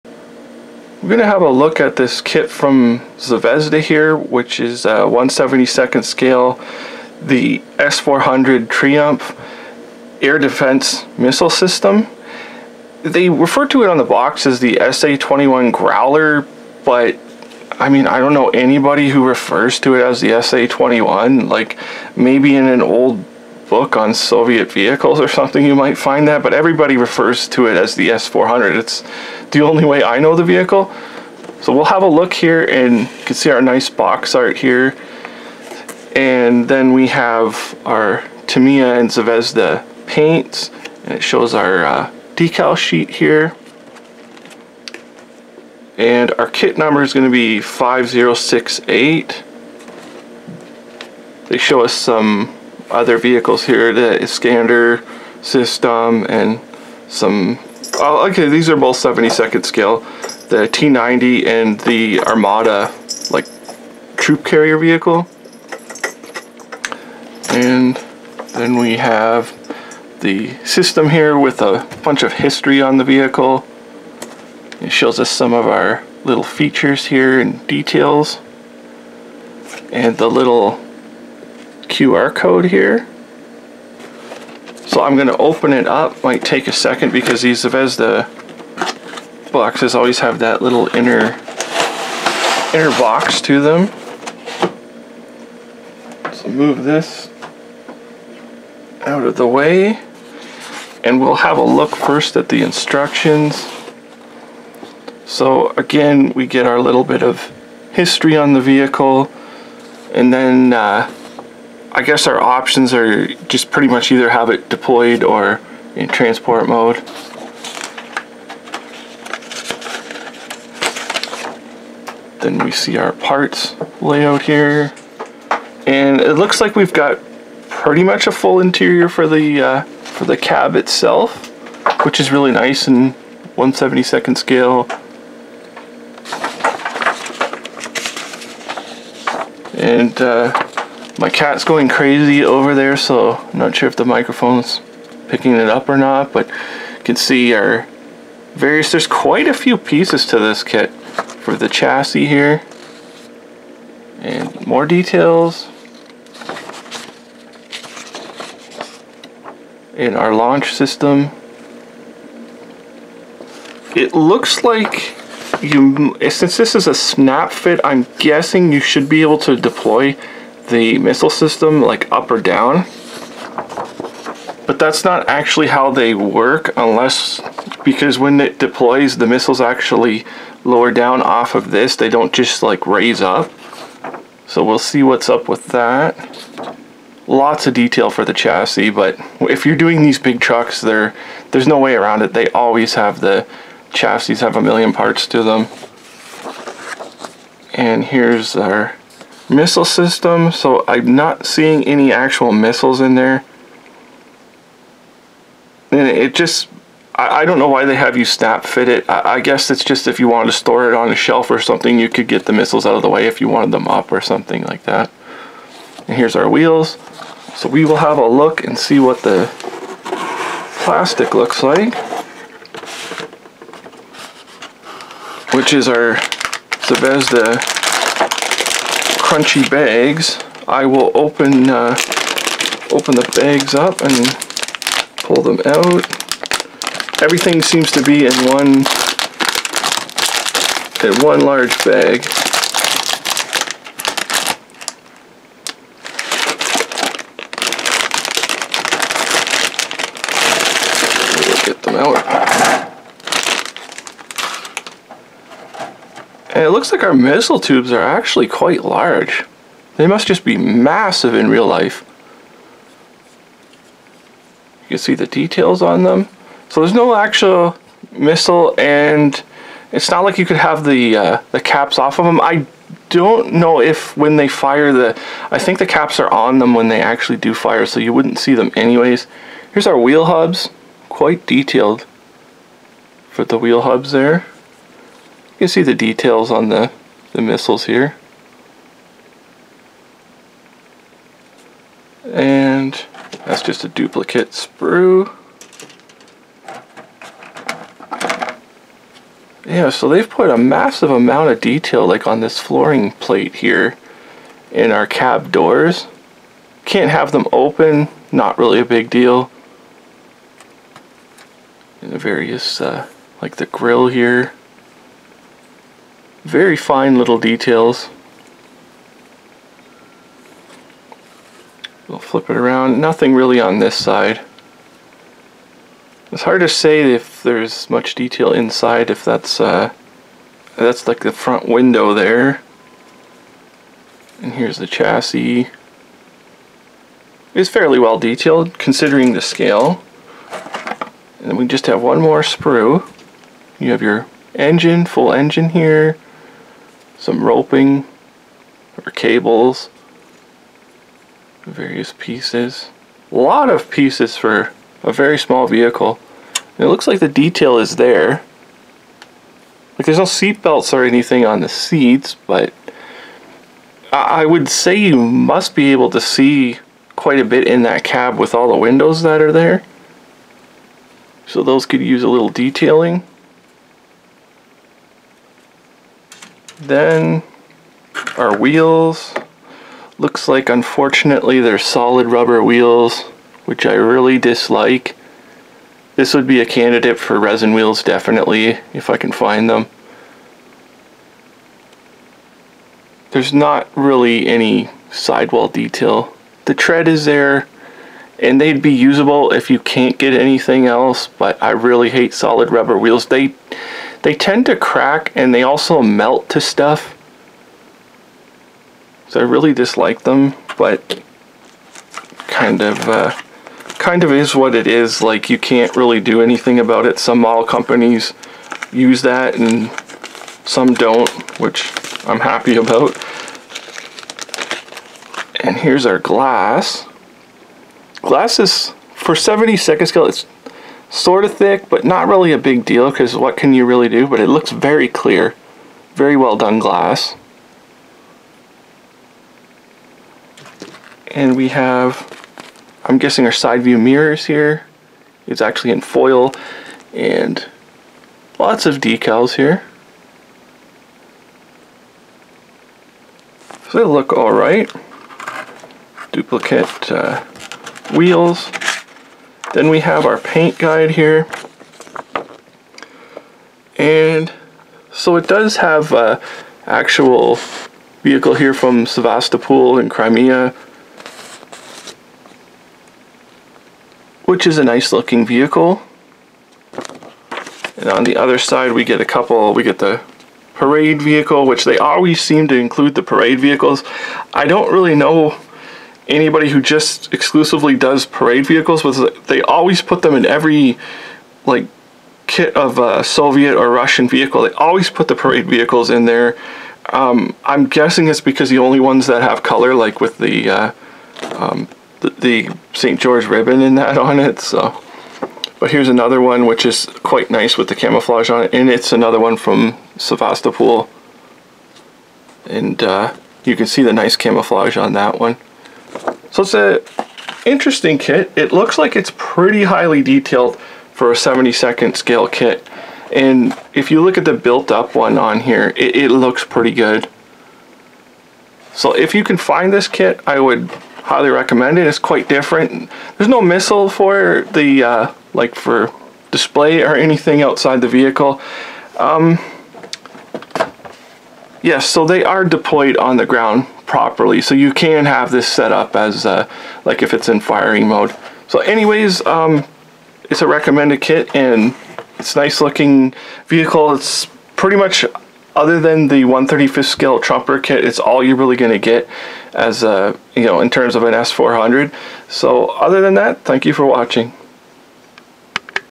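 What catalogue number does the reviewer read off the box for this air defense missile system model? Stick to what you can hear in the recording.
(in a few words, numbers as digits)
5068.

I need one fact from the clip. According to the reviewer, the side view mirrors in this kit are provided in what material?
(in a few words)
Foil.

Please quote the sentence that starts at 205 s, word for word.
And it just, I, I don't know why they have you snap fit it.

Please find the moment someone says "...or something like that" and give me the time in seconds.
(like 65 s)
214 s.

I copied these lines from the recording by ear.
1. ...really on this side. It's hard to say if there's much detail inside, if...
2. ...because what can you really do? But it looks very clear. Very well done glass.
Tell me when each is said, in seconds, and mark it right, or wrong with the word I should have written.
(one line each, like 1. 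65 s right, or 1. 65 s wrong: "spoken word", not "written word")
1. 323 s right
2. 433 s right.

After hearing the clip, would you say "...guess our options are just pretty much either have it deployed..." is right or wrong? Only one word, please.
right.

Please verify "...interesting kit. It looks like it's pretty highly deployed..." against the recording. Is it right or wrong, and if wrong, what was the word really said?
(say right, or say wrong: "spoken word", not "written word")
wrong: "detailed", not "deployed".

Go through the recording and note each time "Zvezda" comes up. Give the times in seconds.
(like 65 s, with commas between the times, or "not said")
3 s, 39 s, 87 s, 226 s.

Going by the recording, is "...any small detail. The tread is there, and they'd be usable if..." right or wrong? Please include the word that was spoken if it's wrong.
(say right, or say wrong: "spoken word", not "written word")
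wrong: "sidewall", not "small".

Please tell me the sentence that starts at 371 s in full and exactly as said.
So those could use a little detailing.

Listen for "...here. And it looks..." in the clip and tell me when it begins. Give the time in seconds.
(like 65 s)
124 s.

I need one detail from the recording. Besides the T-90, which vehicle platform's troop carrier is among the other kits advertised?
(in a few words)
Armata.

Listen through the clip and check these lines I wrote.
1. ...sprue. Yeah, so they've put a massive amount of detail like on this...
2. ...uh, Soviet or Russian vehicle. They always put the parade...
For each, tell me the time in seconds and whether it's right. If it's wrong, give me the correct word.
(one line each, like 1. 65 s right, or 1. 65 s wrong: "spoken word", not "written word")
1. 294 s right
2. 493 s right.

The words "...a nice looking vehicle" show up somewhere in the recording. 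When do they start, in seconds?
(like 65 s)
474 s.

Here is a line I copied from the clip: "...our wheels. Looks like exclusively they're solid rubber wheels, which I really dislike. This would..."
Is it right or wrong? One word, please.
wrong.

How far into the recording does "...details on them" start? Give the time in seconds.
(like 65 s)
265 s.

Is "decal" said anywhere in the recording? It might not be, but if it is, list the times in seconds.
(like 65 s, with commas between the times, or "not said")
42 s, 448 s.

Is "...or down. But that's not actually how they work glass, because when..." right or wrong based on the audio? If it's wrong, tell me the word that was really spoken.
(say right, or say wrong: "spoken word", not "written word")
wrong: "unless", not "glass".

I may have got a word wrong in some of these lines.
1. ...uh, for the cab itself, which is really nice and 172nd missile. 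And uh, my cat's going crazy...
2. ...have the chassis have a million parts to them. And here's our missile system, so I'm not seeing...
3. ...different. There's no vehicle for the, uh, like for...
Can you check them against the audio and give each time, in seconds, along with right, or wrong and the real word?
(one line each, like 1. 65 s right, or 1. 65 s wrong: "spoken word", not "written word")
1. 129 s wrong: "scale", not "missile"
2. 192 s right
3. 532 s wrong: "missile", not "vehicle".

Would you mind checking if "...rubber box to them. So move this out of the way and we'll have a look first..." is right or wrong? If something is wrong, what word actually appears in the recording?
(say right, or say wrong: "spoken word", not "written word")
wrong: "inner", not "rubber".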